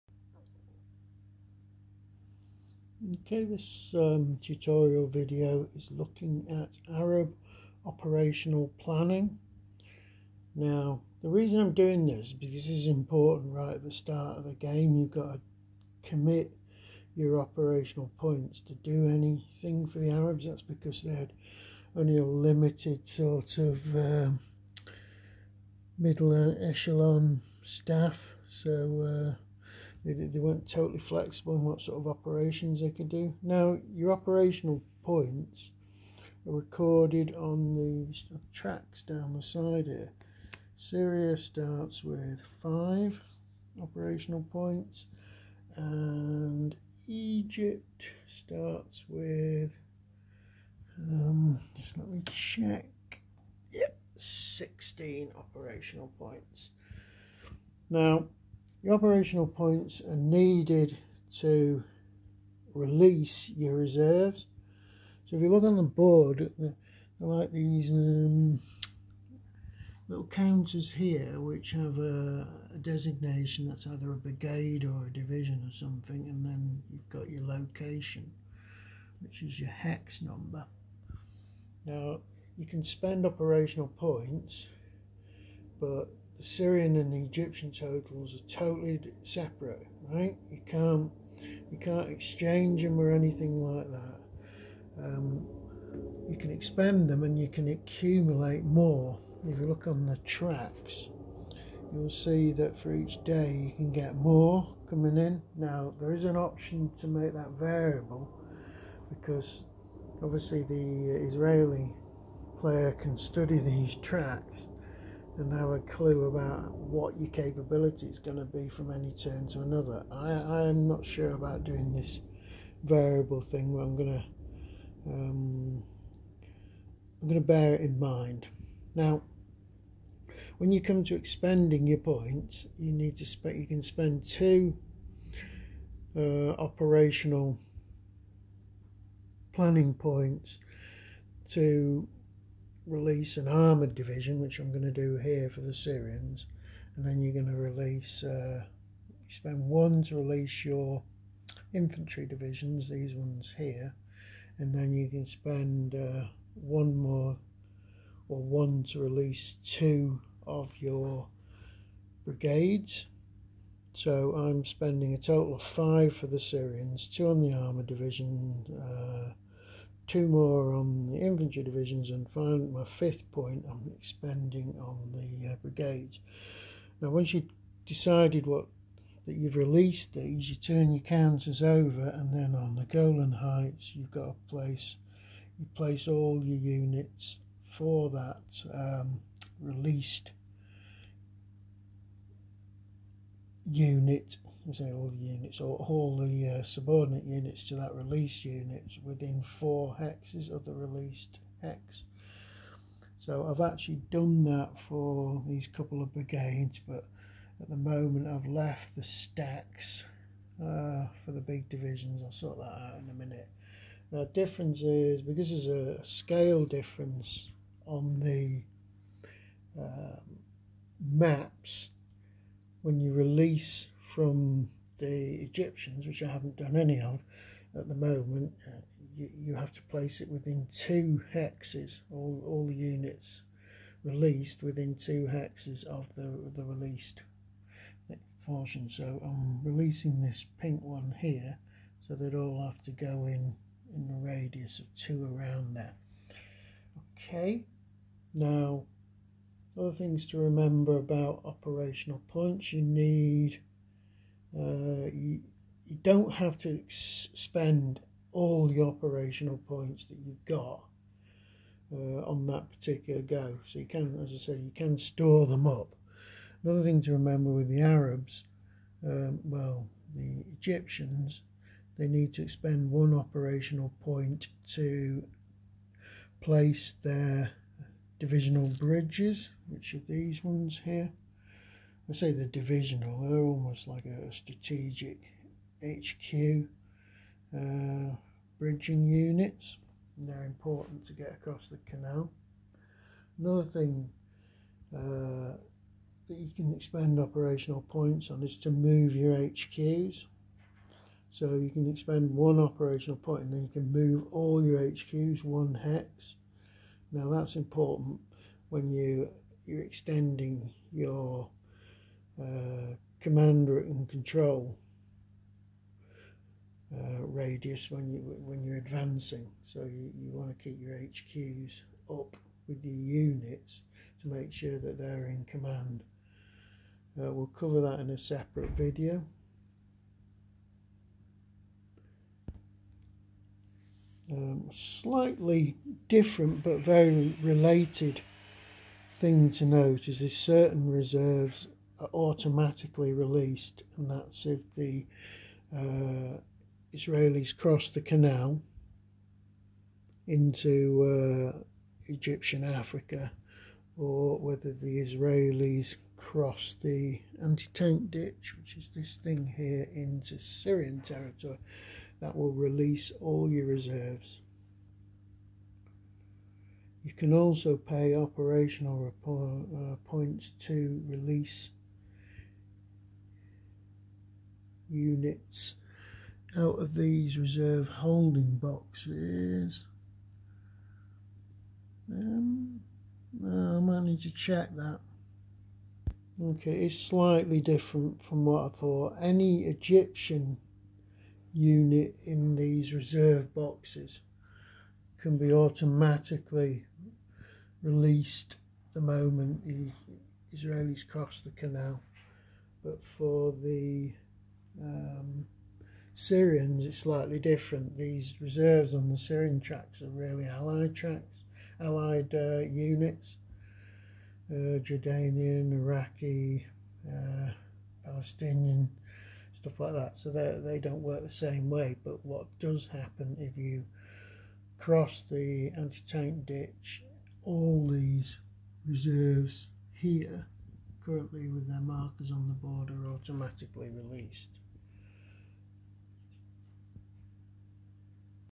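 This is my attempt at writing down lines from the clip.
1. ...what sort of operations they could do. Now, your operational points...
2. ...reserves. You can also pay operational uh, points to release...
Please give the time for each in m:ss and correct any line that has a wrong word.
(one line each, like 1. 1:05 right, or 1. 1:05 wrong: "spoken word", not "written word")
1. 0:31 right
2. 6:03 right.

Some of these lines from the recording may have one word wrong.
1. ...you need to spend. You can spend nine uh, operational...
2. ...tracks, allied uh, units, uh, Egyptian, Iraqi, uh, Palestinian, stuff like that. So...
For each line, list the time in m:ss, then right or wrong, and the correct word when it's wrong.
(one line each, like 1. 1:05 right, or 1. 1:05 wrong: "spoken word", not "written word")
1. 2:12 wrong: "two", not "nine"
2. 6:50 wrong: "Jordanian", not "Egyptian".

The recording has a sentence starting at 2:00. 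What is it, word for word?
I, I am not sure about doing this variable thing, but I'm going to um, I'm going to bear it in mind.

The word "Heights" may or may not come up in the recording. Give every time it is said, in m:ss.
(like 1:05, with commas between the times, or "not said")
3:03.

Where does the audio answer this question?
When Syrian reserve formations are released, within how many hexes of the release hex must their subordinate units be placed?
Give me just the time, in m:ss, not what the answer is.
3:19.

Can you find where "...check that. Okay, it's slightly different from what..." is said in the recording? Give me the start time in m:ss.
6:24.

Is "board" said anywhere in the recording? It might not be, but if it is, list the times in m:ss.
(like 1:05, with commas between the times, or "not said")
1:05, 7:12.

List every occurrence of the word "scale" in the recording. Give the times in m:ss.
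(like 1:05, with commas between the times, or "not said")
3:36.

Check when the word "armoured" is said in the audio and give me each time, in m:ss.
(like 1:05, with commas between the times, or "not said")
2:23, 2:47.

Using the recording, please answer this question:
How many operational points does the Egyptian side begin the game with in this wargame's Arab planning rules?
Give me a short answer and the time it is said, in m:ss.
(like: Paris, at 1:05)
16, at 0:54.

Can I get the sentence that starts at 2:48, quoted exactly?
Uh, two more on the infantry divisions and finally my fifth point I'm expanding on the uh, brigades.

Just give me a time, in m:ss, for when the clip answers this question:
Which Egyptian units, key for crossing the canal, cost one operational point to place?
4:38.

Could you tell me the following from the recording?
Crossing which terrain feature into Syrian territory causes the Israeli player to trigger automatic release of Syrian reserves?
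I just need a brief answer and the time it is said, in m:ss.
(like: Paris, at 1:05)
Anti-tank ditch, at 5:57.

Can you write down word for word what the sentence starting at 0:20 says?
That's because they had only a limited sort of um, middle echelon staff.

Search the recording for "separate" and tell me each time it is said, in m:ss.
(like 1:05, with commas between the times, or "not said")
1:29, 5:28.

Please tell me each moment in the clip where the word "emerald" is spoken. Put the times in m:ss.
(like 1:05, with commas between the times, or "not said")
not said.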